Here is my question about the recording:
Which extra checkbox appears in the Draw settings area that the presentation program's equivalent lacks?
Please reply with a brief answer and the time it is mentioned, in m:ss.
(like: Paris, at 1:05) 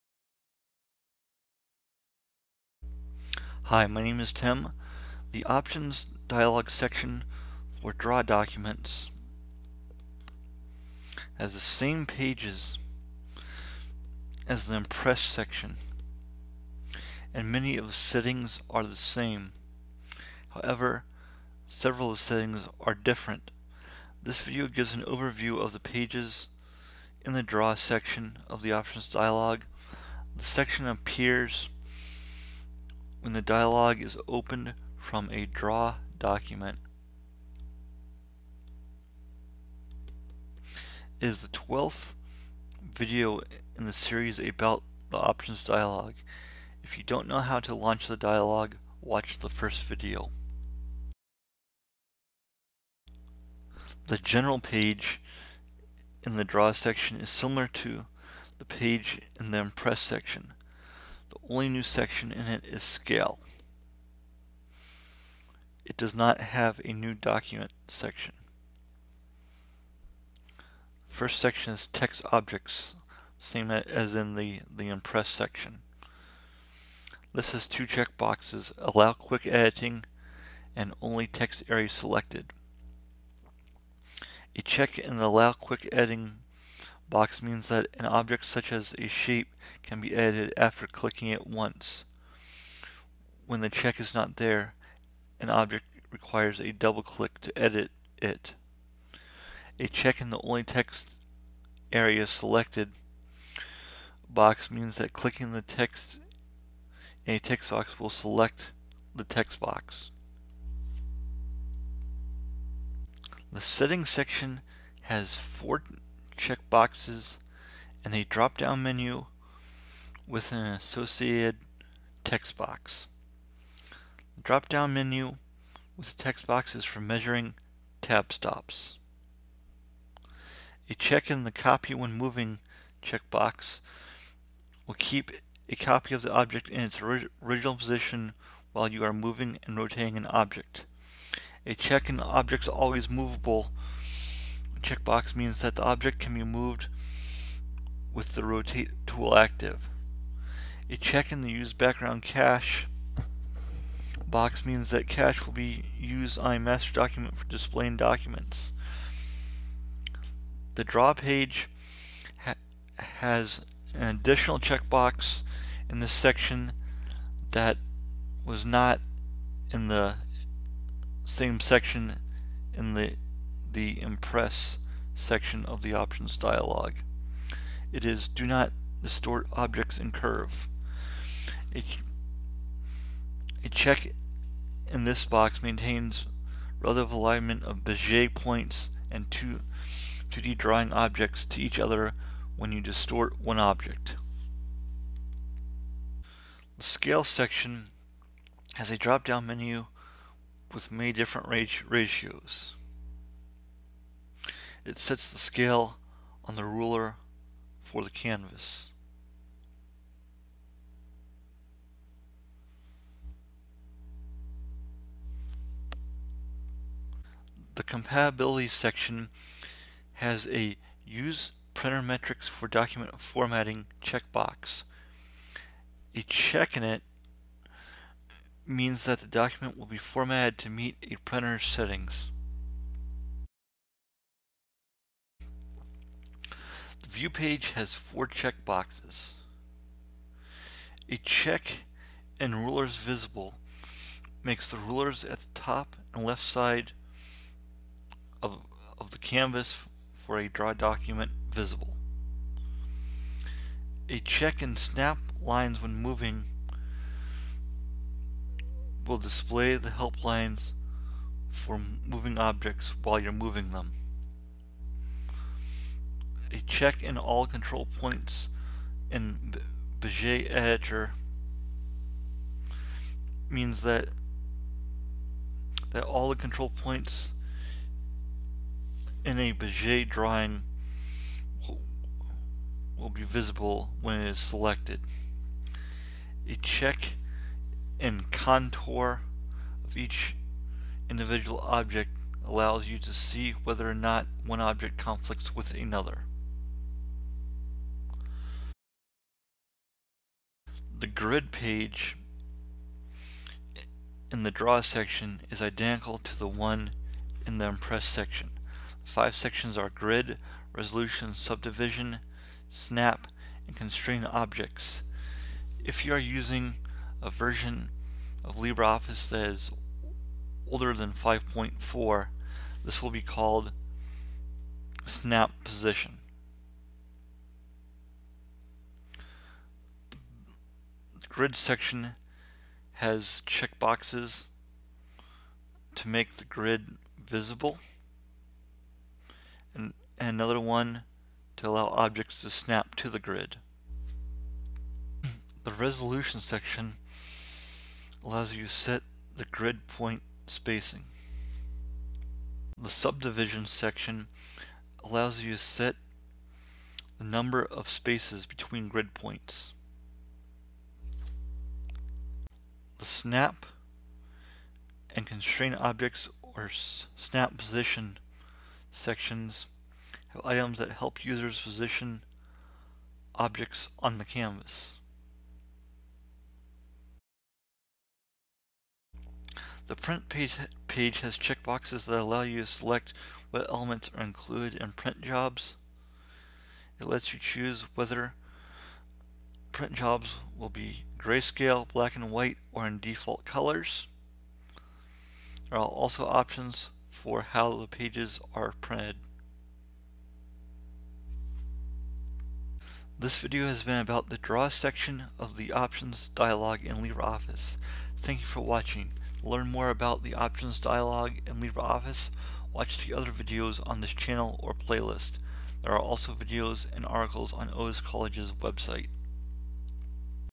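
Do Not Distort Objects in Curve, at 2:58.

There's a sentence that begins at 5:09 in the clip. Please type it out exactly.
five sections are grid, resolution, subdivision, snap, and constrain objects.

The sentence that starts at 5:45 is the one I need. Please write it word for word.
The resolution section allows you to set the grid point spacing.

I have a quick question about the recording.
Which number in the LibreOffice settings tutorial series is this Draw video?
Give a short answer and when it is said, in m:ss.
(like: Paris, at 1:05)
12th, at 0:41.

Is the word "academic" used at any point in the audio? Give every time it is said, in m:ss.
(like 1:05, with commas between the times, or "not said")
not said.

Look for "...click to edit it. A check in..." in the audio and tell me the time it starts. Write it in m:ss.
1:37.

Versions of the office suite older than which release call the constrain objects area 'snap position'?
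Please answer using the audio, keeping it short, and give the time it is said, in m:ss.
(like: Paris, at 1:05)
5.4, at 5:21.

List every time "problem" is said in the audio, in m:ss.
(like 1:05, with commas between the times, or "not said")
not said.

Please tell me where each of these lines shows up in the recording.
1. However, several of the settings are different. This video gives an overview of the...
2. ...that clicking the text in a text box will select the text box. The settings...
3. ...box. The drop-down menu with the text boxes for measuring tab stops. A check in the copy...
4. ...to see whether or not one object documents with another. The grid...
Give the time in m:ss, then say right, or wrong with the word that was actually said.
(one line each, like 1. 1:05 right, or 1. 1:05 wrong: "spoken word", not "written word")
1. 0:20 right
2. 1:44 right
3. 2:02 right
4. 4:52 wrong: "conflicts", not "documents".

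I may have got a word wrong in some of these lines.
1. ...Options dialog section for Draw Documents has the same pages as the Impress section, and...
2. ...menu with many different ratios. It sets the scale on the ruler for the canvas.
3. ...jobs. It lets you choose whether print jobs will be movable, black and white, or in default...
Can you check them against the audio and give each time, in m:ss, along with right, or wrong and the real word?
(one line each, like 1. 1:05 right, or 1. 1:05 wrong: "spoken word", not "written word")
1. 0:05 right
2. 3:19 right
3. 6:25 wrong: "grayscale", not "movable".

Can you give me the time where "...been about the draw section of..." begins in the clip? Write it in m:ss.
6:43.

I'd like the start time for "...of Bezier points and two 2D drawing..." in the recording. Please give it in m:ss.
3:07.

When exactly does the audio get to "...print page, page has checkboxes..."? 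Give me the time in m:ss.
6:19.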